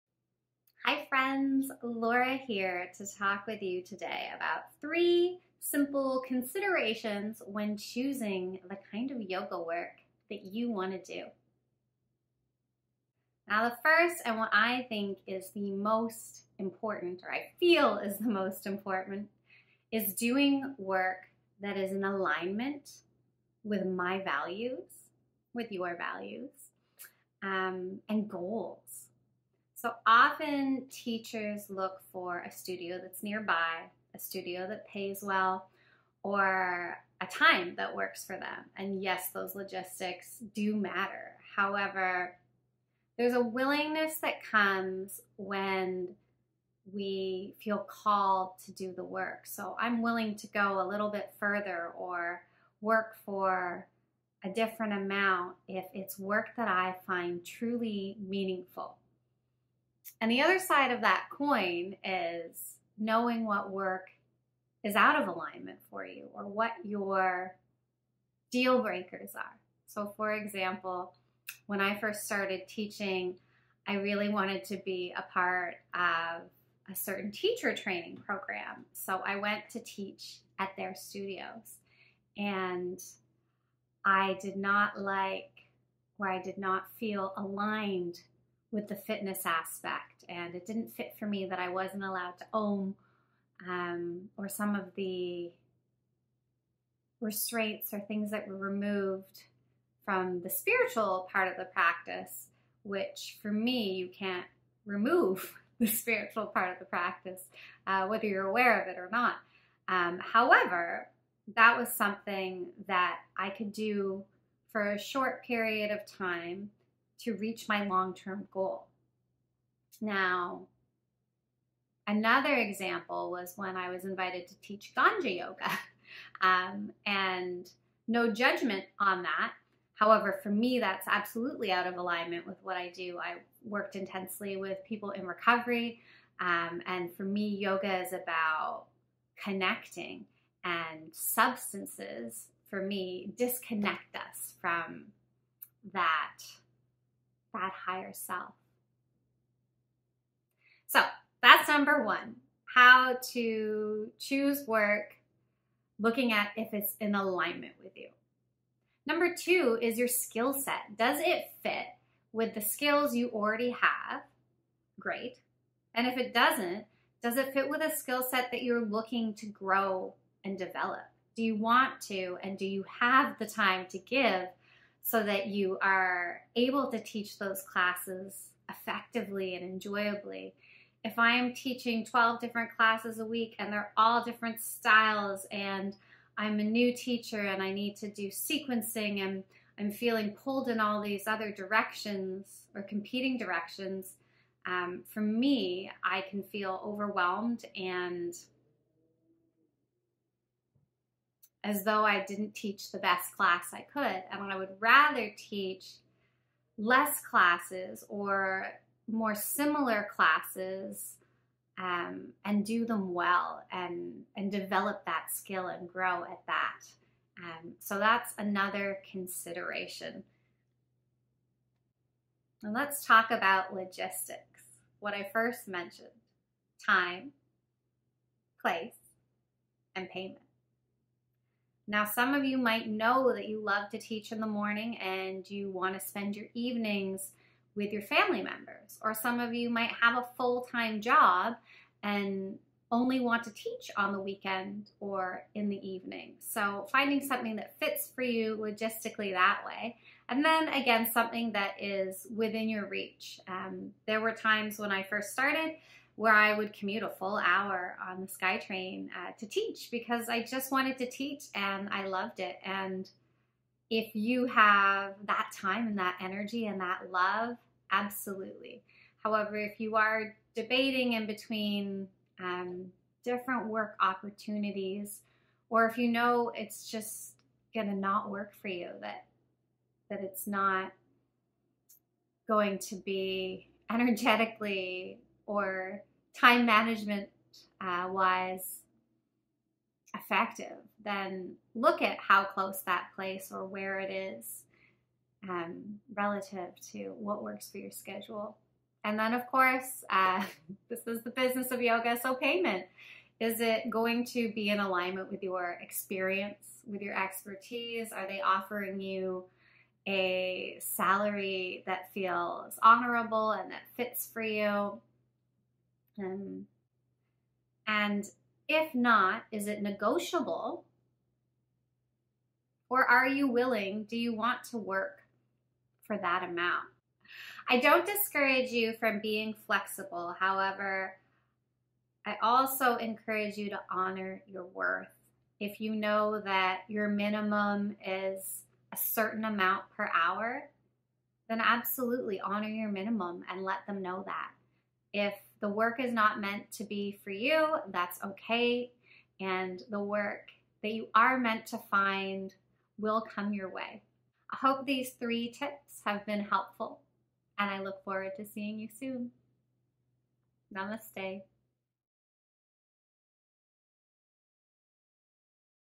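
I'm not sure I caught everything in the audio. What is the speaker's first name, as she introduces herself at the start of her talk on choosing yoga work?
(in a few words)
Laura.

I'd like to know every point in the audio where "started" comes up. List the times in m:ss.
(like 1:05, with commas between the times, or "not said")
1:12, 4:15.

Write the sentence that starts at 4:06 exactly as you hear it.
So, finding something that fits for you logistically that way.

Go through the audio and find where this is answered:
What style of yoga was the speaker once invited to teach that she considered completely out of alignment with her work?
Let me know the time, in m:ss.
2:04.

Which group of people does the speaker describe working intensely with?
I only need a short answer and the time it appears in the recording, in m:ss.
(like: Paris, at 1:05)
People in recovery, at 2:14.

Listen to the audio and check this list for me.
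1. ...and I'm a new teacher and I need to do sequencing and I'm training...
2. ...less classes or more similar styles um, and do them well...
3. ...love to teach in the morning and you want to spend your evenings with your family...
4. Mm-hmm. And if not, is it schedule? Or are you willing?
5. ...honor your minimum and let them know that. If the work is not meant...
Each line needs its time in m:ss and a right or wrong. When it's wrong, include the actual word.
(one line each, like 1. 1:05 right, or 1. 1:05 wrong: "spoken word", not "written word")
1. 3:05 wrong: "feeling", not "training"
2. 3:26 wrong: "classes", not "styles"
3. 3:53 right
4. 5:16 wrong: "negotiable", not "schedule"
5. 5:42 right.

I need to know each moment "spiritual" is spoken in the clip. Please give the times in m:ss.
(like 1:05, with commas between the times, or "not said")
1:40, 1:45.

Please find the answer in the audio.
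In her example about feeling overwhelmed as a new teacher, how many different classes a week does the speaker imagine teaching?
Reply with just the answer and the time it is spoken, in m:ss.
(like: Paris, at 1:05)
12, at 3:02.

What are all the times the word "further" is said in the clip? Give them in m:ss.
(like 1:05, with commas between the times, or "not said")
0:51.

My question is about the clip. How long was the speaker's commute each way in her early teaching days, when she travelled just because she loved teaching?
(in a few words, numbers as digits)
A full hour.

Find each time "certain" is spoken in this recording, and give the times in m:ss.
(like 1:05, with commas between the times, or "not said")
1:16, 5:38.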